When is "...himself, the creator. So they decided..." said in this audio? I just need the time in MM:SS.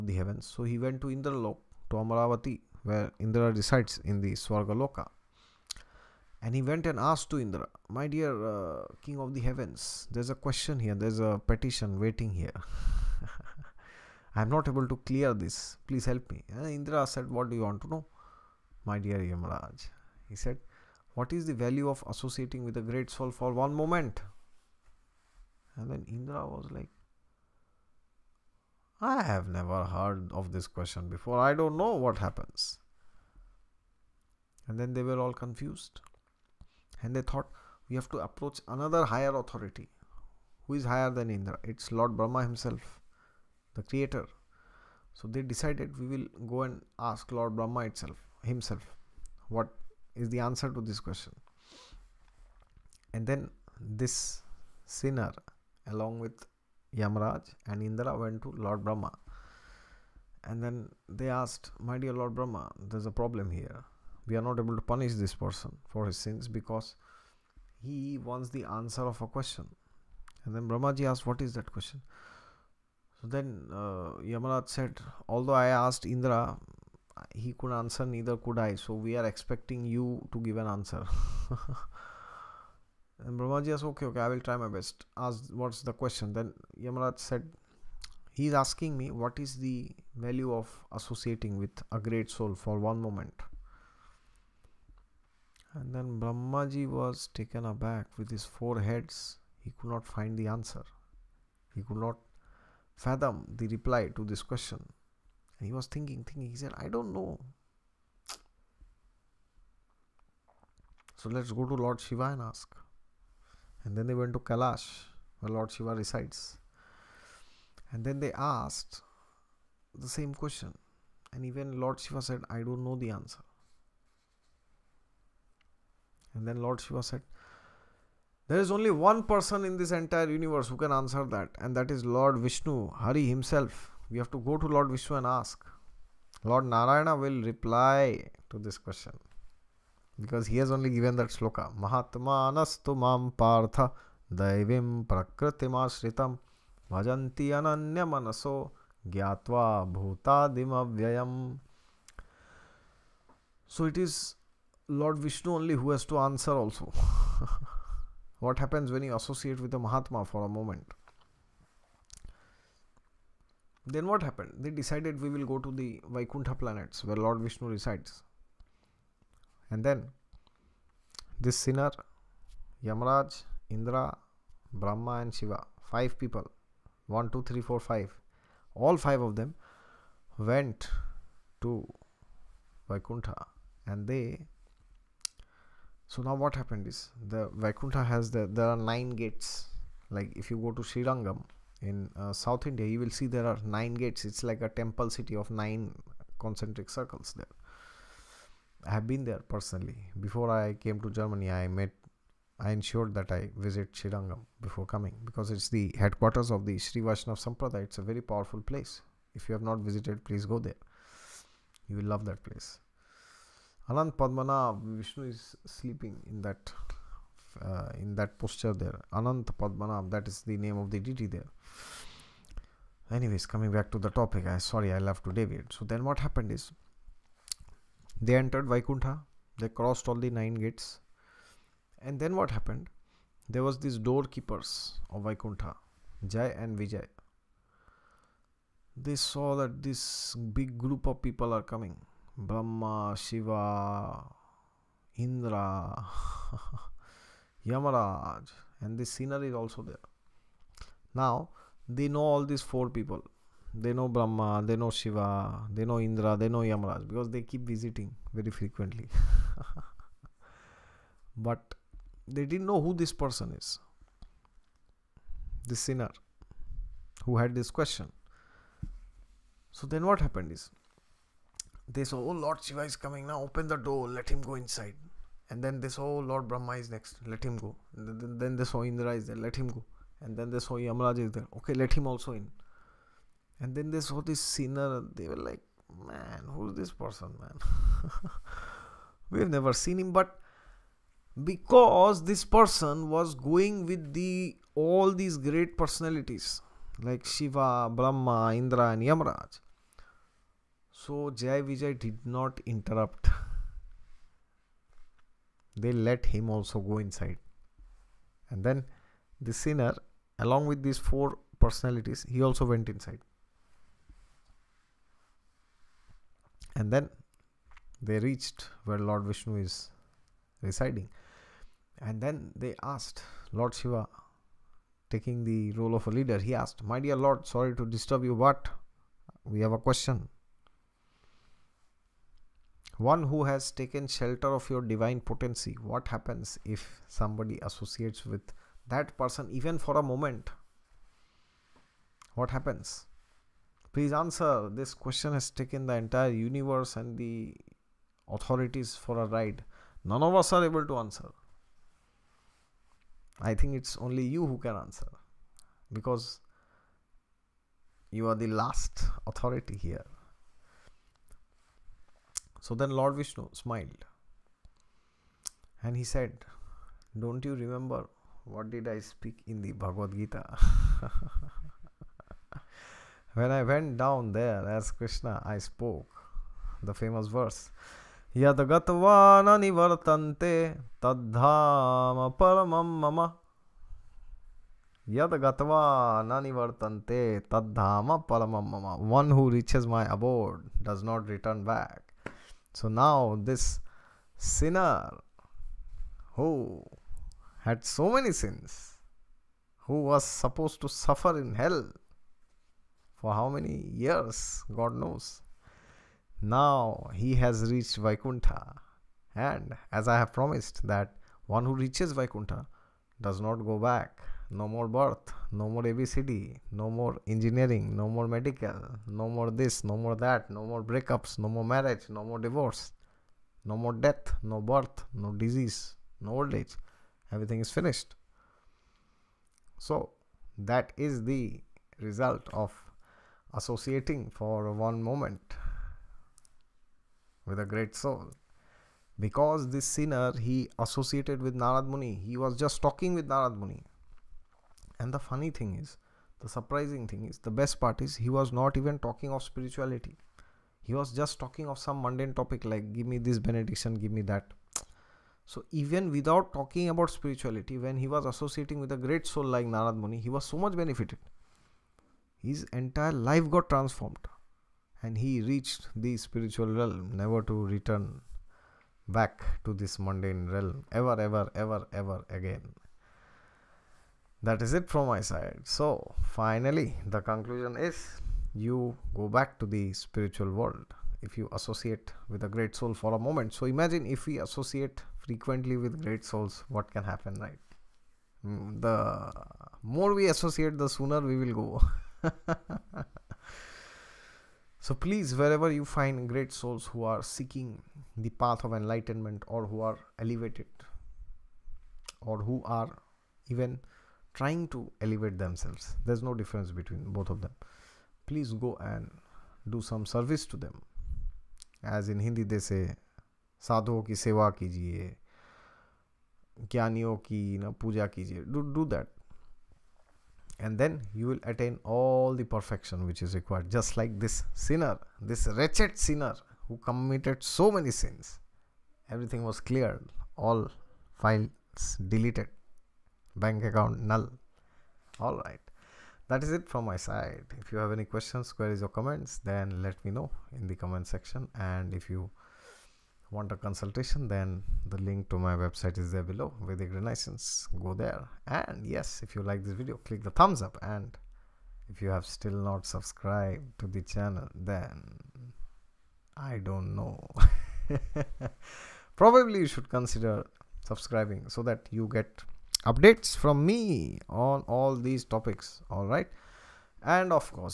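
00:42.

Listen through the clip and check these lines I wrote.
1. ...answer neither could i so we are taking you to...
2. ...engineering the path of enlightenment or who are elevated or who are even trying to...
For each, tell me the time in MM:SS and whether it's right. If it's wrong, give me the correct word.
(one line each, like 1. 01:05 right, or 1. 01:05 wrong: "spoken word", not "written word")
1. 01:17 wrong: "expecting", not "taking"
2. 08:17 wrong: "seeking", not "engineering".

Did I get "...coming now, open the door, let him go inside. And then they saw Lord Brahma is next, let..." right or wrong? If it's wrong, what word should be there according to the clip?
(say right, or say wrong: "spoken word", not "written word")
right.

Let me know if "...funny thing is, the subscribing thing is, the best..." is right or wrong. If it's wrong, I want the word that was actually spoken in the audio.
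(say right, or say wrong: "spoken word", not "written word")
wrong: "surprising", not "subscribing".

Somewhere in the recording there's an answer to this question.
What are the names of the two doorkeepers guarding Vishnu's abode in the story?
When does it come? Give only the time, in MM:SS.
03:56.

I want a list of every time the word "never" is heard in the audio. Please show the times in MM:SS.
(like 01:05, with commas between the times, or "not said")
00:29, 04:49, 07:47.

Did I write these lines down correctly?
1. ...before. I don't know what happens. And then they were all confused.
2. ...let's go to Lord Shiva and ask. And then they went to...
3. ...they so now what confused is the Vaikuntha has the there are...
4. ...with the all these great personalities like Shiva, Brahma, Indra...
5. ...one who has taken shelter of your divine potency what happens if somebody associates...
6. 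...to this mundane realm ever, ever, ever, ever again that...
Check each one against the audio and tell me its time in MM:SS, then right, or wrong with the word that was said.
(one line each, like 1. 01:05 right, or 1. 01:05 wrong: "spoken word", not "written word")
1. 00:31 right
2. 01:51 right
3. 03:04 wrong: "happened", not "confused"
4. 04:53 right
5. 05:32 right
6. 07:49 right.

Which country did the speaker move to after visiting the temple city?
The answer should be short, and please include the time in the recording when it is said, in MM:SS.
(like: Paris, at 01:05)
Germany, at 03:21.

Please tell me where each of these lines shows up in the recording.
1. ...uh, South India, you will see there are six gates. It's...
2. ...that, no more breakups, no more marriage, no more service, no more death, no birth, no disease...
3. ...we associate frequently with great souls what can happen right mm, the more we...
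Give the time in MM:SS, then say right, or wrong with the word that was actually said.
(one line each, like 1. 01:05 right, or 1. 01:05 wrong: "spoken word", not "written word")
1. 03:12 wrong: "nine", not "six"
2. 07:00 wrong: "divorce", not "service"
3. 08:04 right.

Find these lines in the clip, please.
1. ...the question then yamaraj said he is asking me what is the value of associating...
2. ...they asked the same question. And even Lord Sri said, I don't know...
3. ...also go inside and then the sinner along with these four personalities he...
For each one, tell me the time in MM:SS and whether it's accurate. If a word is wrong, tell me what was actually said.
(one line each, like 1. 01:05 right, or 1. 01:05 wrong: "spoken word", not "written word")
1. 01:25 right
2. 01:58 wrong: "Shiva", not "Sri"
3. 05:06 right.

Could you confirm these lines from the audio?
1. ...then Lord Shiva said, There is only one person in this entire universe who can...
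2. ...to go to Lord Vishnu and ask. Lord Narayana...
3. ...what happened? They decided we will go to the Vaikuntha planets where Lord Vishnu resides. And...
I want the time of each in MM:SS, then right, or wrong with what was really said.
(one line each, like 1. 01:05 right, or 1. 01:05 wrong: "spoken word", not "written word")
1. 02:06 right
2. 02:14 right
3. 02:44 right.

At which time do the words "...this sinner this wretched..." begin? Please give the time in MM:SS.
08:44.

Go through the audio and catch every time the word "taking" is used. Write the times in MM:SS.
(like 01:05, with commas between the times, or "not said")
05:25.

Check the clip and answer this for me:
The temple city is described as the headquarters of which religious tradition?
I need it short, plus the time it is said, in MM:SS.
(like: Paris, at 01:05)
Sri Vaishnav Sampradaya, at 03:26.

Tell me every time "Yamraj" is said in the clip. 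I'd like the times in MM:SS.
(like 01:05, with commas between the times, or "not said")
00:56, 02:52, 04:40, 04:59.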